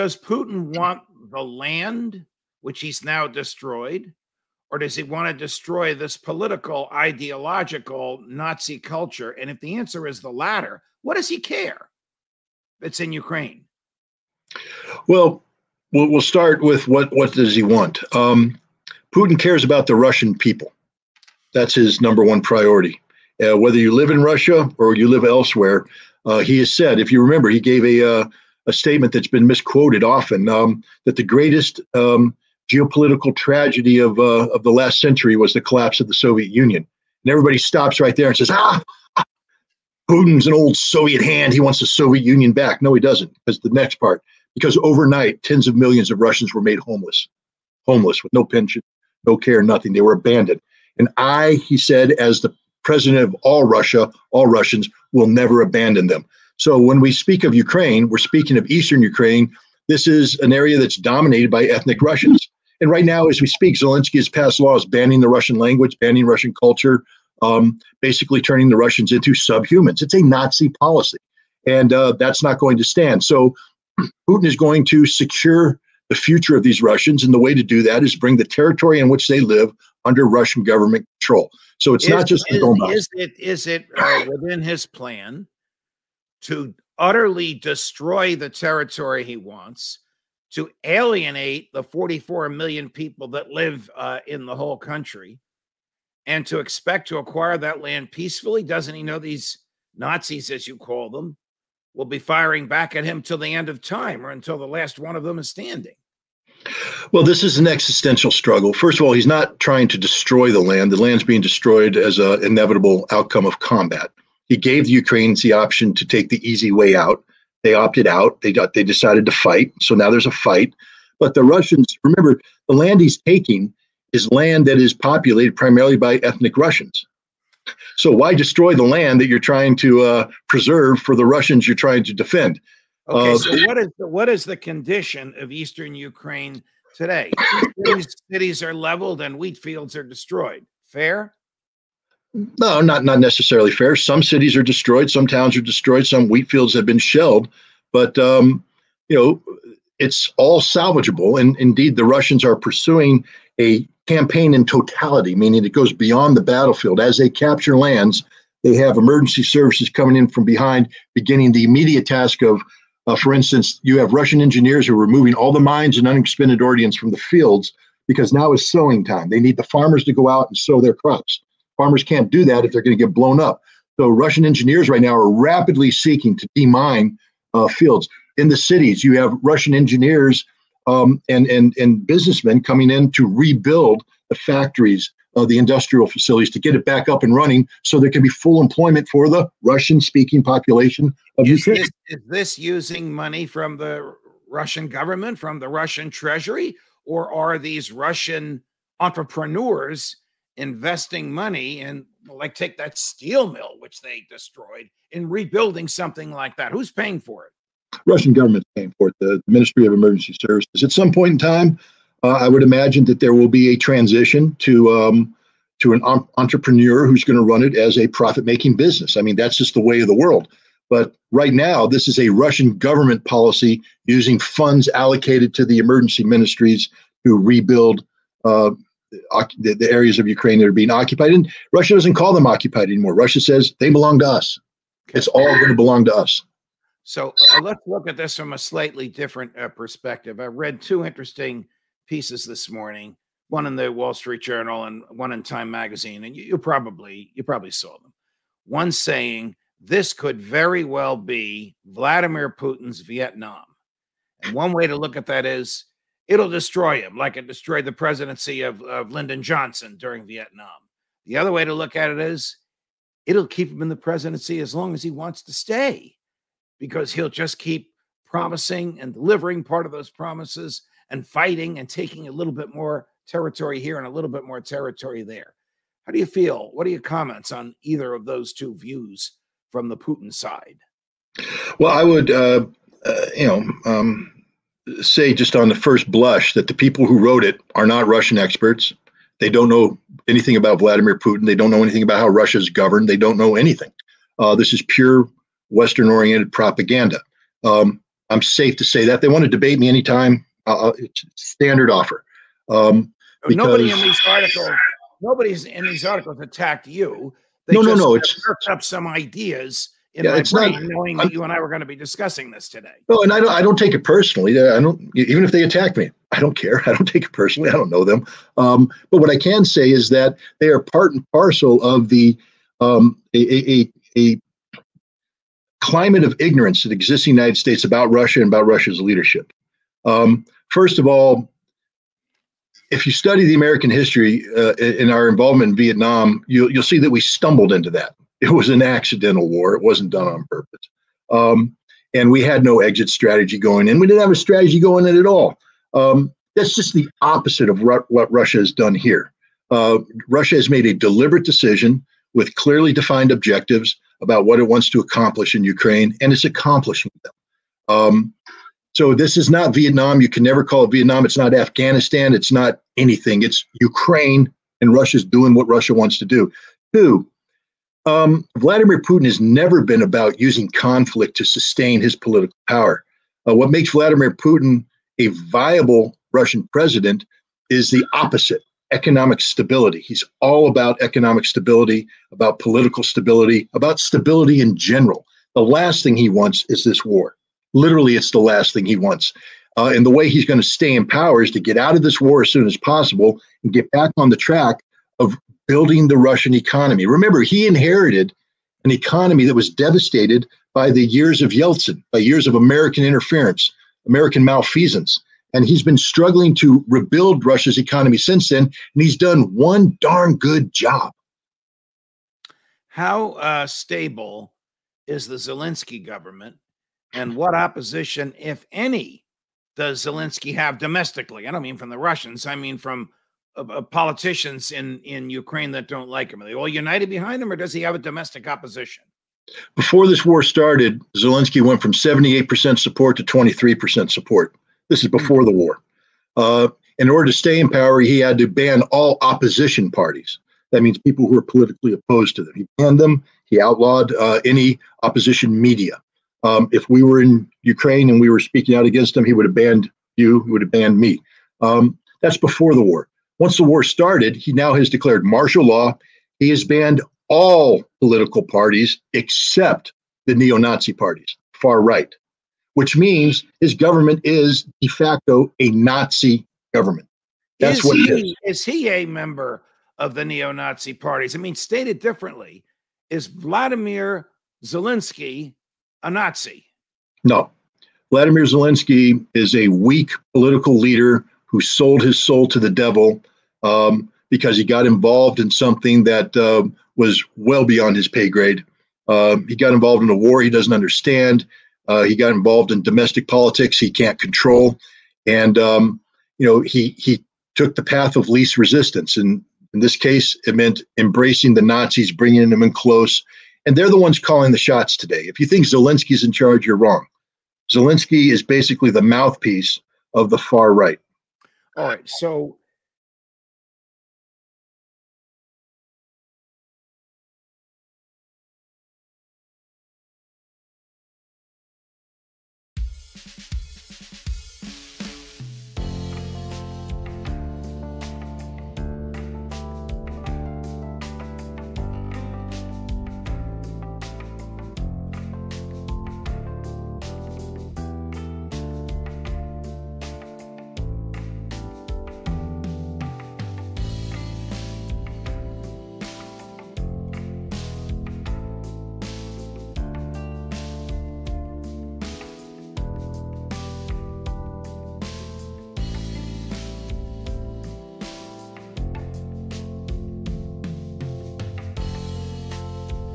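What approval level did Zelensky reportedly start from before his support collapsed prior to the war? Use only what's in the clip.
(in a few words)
78%.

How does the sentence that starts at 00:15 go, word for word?
Well, we'll, we'll start with what what does he want?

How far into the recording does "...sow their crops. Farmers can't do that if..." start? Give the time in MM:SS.
02:50.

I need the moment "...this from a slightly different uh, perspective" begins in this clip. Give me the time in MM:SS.
03:58.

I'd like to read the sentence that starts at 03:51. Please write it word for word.
And Russia doesn't call them occupied anymore.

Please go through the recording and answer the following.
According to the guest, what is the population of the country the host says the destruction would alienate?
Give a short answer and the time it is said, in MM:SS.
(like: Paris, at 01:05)
44 million, at 01:31.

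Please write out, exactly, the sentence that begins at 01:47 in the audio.
Well, this is an existential struggle.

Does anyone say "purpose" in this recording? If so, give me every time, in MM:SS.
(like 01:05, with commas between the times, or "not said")
05:40.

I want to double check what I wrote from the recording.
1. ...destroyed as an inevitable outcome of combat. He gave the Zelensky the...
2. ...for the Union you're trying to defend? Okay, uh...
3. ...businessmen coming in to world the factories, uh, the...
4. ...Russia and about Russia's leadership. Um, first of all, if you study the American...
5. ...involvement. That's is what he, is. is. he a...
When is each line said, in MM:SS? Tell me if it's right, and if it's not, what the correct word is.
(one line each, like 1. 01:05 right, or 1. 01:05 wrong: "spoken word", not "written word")
1. 01:51 wrong: "Ukrainians", not "Zelensky"
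2. 02:10 wrong: "Russians", not "Union"
3. 03:02 wrong: "rebuild", not "world"
4. 05:28 right
5. 07:46 wrong: "government", not "involvement".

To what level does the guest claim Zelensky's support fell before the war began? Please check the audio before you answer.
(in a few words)
23%.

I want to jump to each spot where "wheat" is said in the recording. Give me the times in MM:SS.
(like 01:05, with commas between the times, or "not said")
02:19, 02:26.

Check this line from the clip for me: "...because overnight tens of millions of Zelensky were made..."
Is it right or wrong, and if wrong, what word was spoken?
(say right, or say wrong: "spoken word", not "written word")
wrong: "Russians", not "Zelensky".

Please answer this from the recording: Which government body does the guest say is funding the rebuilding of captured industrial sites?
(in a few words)
Ministry of Emergency Services.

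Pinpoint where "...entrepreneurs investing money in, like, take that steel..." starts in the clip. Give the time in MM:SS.
03:18.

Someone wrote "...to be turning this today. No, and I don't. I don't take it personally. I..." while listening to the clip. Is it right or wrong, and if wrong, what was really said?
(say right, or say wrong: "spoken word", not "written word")
wrong: "discussing", not "turning".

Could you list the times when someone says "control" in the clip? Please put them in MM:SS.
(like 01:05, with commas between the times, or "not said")
01:21, 08:14.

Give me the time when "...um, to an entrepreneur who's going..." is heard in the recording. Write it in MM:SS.
03:34.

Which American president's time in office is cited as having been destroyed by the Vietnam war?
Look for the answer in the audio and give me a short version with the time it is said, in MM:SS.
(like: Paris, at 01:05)
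Lyndon Johnson, at 04:19.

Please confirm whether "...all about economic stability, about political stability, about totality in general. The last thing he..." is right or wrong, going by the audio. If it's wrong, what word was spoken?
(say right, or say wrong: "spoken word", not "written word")
wrong: "stability", not "totality".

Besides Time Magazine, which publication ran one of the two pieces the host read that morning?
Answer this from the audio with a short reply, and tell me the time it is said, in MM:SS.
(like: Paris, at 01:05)
Wall Street Journal, at 04:03.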